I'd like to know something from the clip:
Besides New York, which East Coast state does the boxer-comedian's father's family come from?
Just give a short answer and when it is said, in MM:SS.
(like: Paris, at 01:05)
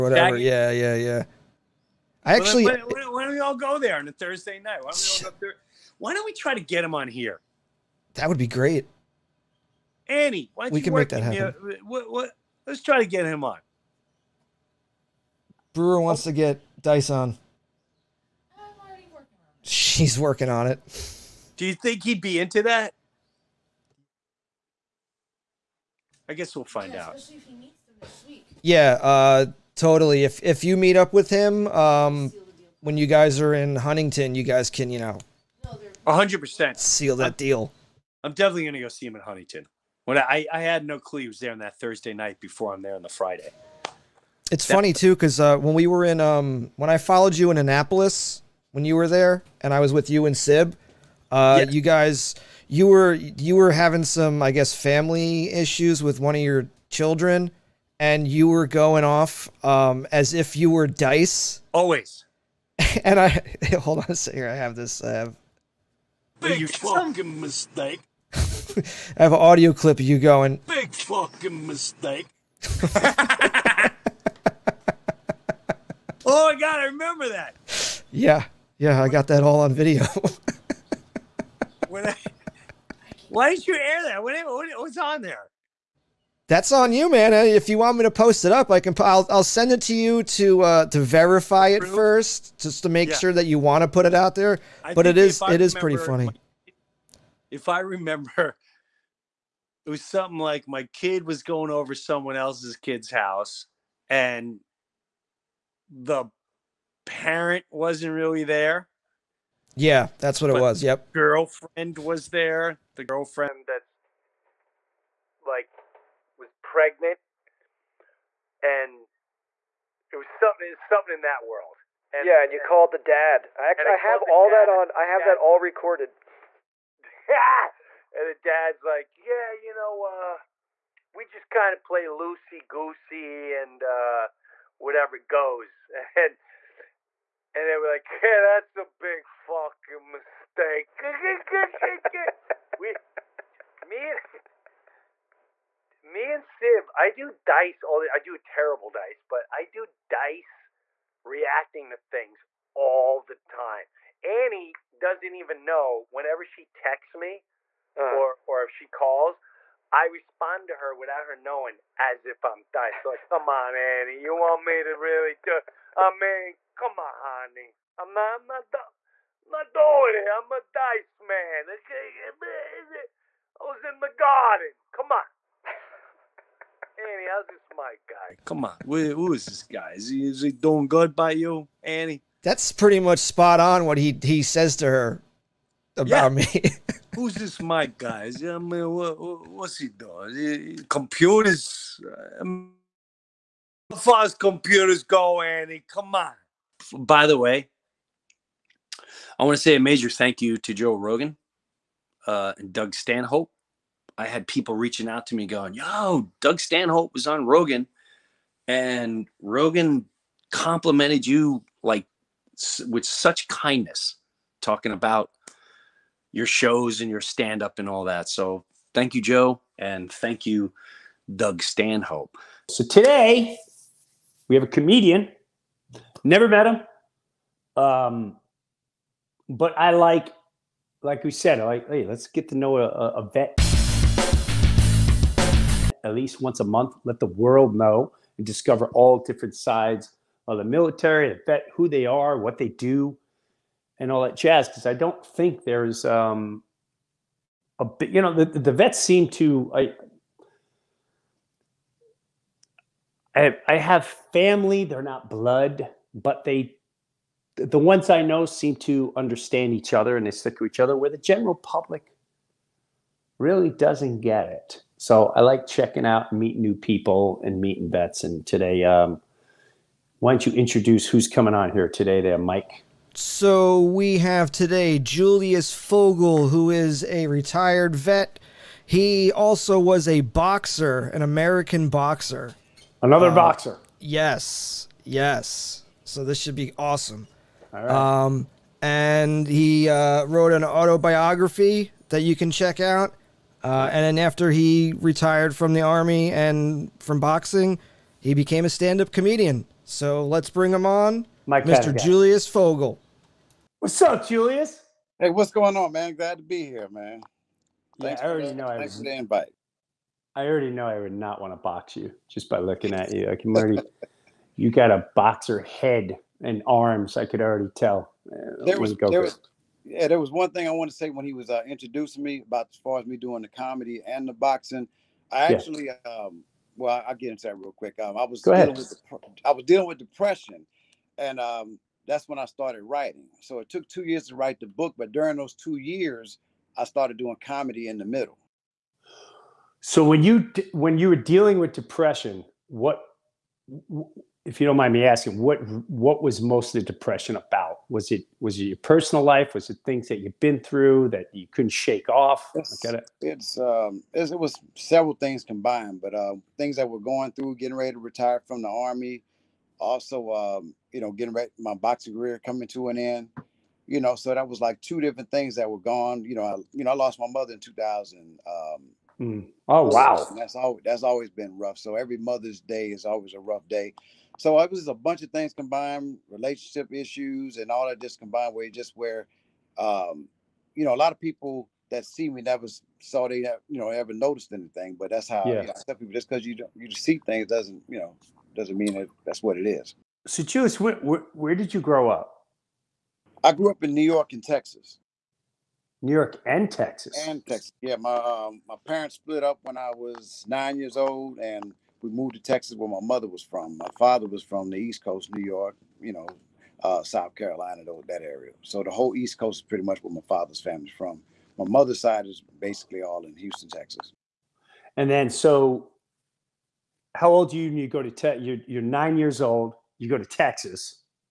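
South Carolina, at 06:47.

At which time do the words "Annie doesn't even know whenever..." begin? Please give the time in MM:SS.
02:34.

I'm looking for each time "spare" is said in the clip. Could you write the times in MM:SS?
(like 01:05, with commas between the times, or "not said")
not said.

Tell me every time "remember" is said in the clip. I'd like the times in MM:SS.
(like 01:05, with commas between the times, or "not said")
01:16, 01:37.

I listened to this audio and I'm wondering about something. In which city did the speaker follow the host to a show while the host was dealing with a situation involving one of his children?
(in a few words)
Annapolis.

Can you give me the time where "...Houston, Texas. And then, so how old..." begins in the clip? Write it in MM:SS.
06:53.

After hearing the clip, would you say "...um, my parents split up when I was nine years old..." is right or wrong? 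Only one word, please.
right.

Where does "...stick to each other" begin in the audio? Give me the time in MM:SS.
04:20.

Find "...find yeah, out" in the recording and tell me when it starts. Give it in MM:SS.
00:26.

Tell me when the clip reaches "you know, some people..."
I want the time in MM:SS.
06:25.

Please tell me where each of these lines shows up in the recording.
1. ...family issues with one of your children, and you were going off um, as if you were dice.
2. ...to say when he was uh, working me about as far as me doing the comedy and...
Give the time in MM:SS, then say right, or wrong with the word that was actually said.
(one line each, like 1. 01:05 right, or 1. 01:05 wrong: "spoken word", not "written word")
1. 00:54 right
2. 05:20 wrong: "introducing", not "working".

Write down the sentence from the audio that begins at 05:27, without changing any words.
Um, I was Go dealing ahead.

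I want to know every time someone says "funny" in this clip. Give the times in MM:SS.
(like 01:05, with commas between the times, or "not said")
00:44, 01:35.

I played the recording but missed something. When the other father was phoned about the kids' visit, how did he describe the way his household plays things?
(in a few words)
loosey goosey.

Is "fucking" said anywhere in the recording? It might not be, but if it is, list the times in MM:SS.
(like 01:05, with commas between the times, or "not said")
01:06, 01:10, 02:19.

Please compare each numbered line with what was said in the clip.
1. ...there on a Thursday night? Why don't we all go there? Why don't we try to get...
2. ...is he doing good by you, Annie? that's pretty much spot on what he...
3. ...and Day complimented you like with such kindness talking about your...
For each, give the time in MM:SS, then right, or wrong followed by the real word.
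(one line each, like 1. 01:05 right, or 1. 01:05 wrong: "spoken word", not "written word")
1. 00:03 right
2. 03:00 right
3. 03:28 wrong: "Rogan", not "Day".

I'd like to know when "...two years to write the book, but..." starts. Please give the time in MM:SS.
05:33.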